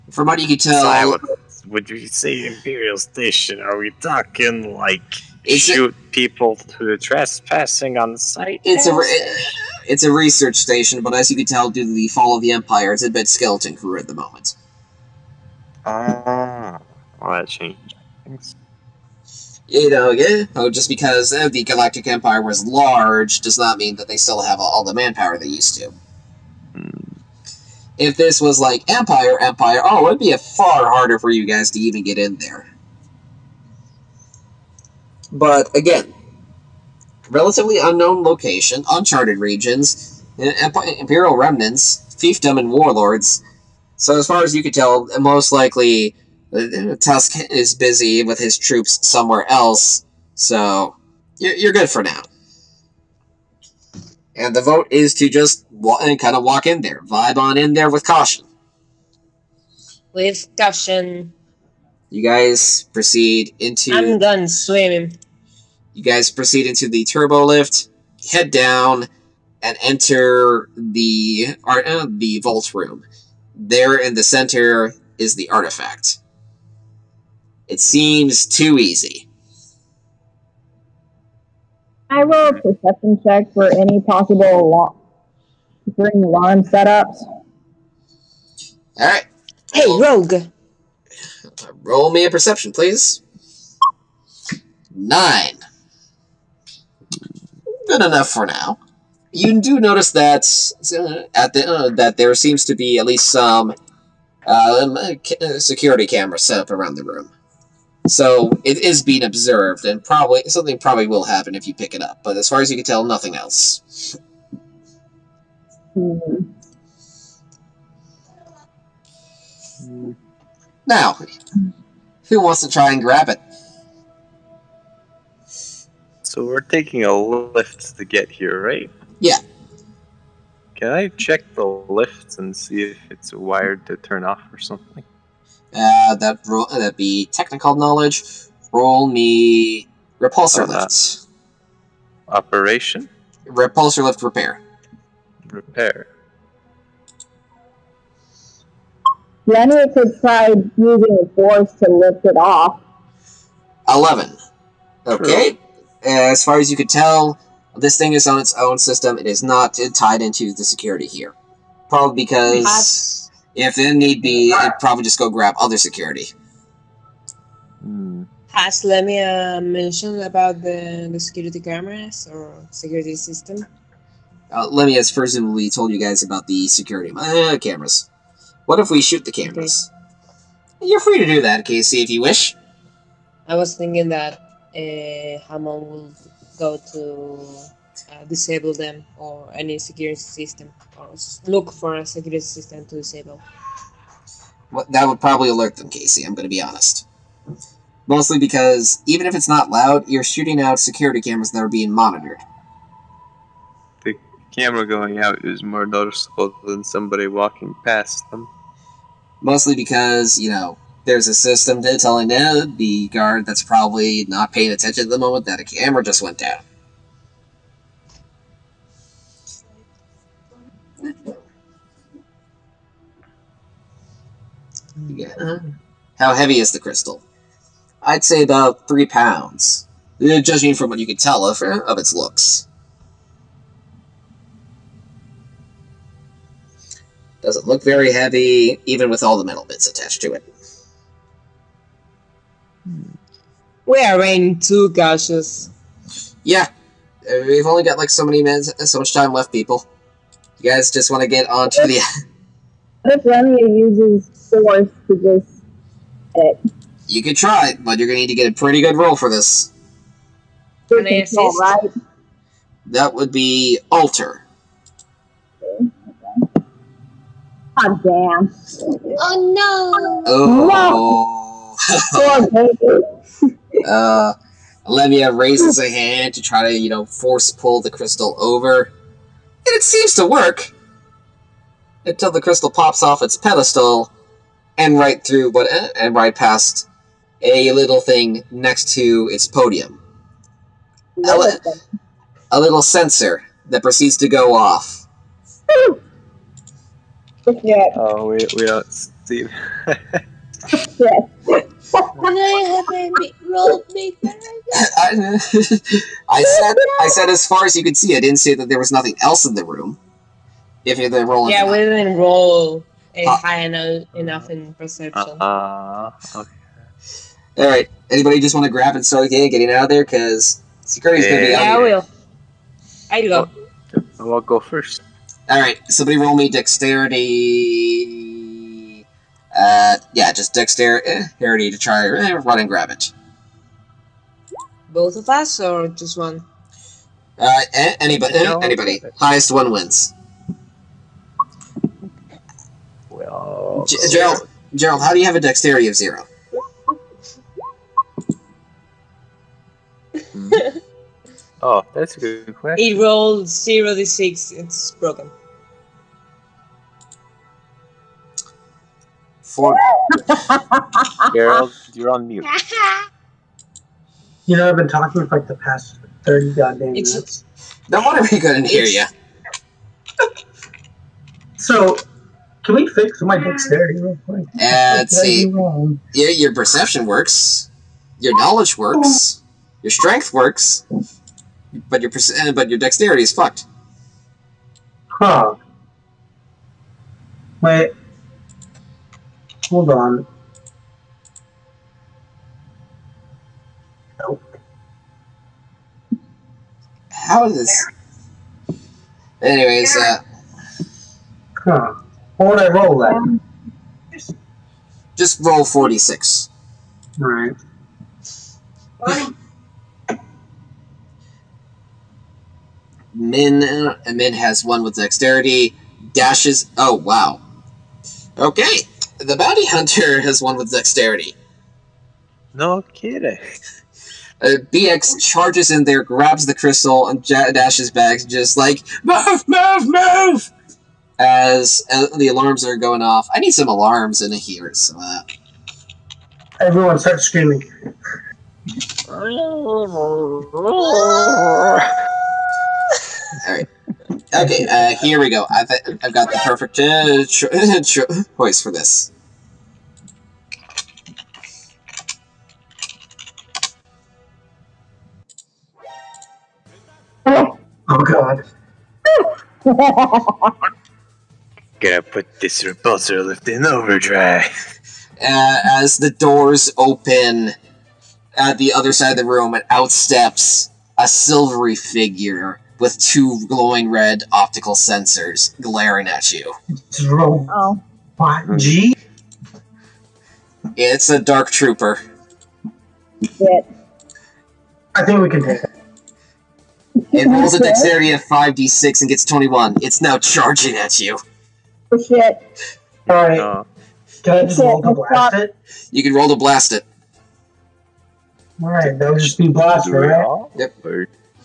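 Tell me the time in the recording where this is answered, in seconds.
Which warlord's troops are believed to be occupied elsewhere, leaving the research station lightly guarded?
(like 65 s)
46 s.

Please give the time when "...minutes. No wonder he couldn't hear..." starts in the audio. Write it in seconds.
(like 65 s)
367 s.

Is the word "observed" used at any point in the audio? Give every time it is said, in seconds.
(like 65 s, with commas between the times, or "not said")
109 s.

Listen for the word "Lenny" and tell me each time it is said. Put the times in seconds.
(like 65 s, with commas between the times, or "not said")
149 s, 253 s.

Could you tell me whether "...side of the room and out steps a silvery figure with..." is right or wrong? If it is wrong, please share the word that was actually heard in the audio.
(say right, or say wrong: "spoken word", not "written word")
right.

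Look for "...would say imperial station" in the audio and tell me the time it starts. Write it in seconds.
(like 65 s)
1 s.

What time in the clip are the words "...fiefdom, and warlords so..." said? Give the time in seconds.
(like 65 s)
42 s.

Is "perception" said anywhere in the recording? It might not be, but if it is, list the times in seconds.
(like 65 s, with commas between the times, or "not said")
82 s, 92 s, 314 s, 376 s.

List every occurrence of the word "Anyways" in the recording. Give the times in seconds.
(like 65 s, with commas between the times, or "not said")
399 s.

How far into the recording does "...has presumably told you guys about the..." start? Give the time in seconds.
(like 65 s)
174 s.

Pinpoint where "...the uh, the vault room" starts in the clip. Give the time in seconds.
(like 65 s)
70 s.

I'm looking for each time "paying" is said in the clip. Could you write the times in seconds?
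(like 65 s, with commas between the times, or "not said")
214 s.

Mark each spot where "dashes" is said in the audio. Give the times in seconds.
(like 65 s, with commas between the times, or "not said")
416 s, 427 s.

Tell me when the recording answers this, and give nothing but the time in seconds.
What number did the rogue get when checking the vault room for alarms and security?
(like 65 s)
94 s.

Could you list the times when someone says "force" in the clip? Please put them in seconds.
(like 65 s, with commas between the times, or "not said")
151 s, 254 s, 277 s.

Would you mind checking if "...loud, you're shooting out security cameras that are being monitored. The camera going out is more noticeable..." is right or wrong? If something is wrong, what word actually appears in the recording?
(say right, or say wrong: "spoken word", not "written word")
right.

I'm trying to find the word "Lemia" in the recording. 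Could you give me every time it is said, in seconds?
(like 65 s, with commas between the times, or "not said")
168 s.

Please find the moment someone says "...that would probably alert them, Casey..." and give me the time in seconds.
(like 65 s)
194 s.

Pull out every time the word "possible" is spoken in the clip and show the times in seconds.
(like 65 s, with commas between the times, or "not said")
83 s.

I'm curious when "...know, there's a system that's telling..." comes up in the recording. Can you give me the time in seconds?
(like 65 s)
210 s.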